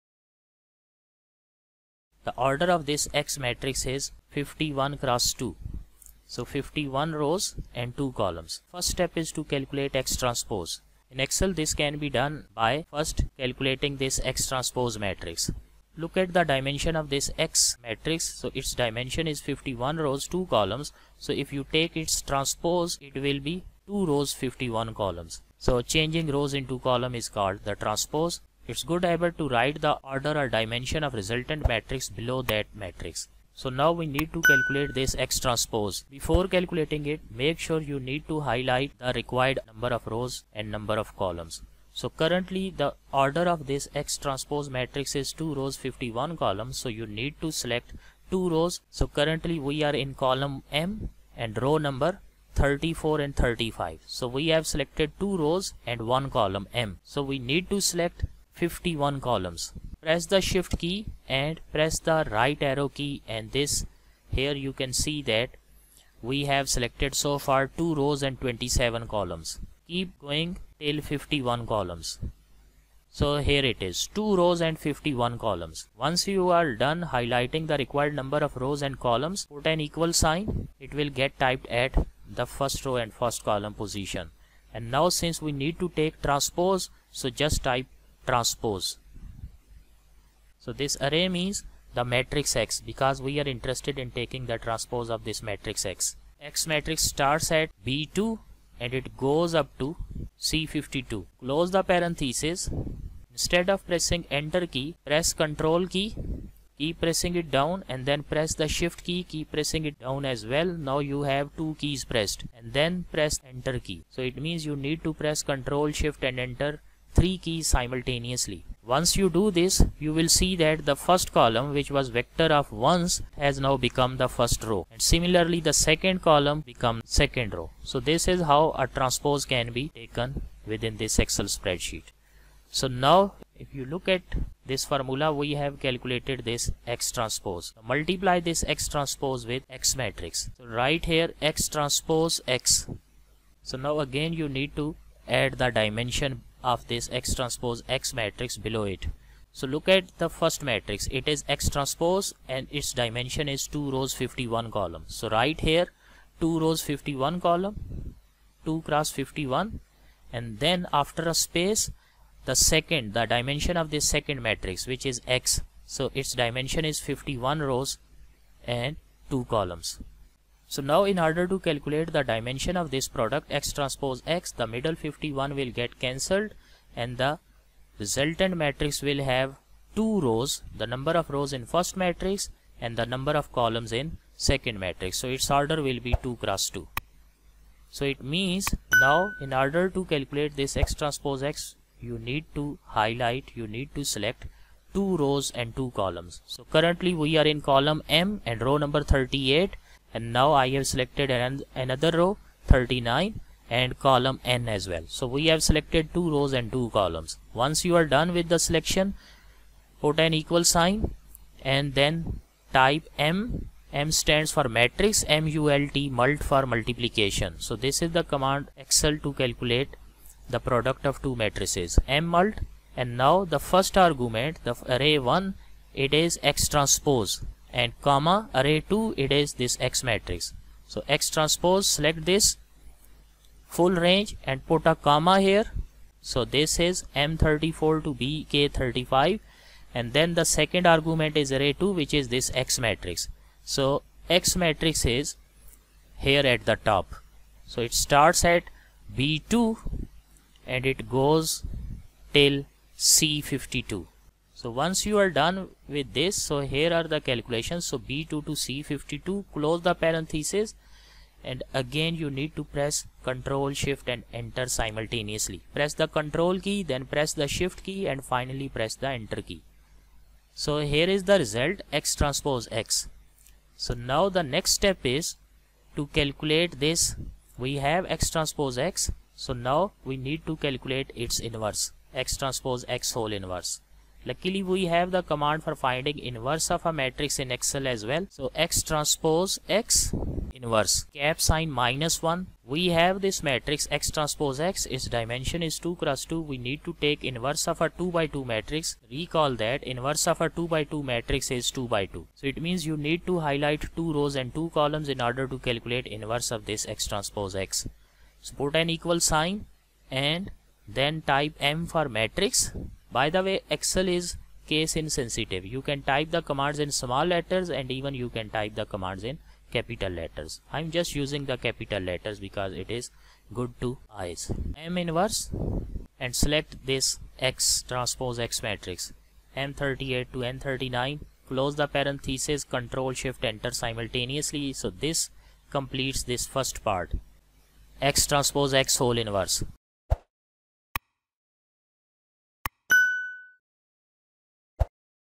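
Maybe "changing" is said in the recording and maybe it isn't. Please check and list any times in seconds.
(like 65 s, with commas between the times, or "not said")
25 s.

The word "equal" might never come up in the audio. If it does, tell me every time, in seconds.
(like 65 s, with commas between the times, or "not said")
79 s, 210 s, 308 s.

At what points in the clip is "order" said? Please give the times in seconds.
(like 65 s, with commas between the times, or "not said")
2 s, 30 s, 43 s, 171 s, 185 s, 189 s, 305 s.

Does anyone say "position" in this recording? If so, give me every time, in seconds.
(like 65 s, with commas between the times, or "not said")
83 s.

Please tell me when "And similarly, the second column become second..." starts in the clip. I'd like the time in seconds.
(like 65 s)
124 s.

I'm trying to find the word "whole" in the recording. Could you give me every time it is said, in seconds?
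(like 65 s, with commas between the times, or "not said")
283 s, 338 s.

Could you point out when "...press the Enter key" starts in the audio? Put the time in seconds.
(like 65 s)
268 s.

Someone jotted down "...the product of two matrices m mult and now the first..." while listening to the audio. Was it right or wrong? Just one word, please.
right.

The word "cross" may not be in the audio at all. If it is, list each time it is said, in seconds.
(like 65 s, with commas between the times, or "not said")
4 s, 158 s, 186 s, 295 s.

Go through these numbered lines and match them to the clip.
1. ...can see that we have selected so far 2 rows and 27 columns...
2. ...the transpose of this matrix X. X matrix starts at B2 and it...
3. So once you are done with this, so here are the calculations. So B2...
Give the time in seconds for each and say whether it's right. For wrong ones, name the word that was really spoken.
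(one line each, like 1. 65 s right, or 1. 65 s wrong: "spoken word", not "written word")
1. 64 s right
2. 94 s right
3. 254 s right.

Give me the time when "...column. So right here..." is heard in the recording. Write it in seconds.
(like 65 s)
154 s.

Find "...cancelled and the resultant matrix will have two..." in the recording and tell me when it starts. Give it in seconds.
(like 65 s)
176 s.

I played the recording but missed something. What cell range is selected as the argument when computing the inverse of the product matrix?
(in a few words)
M38 to N39.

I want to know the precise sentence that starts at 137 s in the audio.
Multiply this X transpose with X matrix.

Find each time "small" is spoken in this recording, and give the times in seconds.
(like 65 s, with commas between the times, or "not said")
316 s.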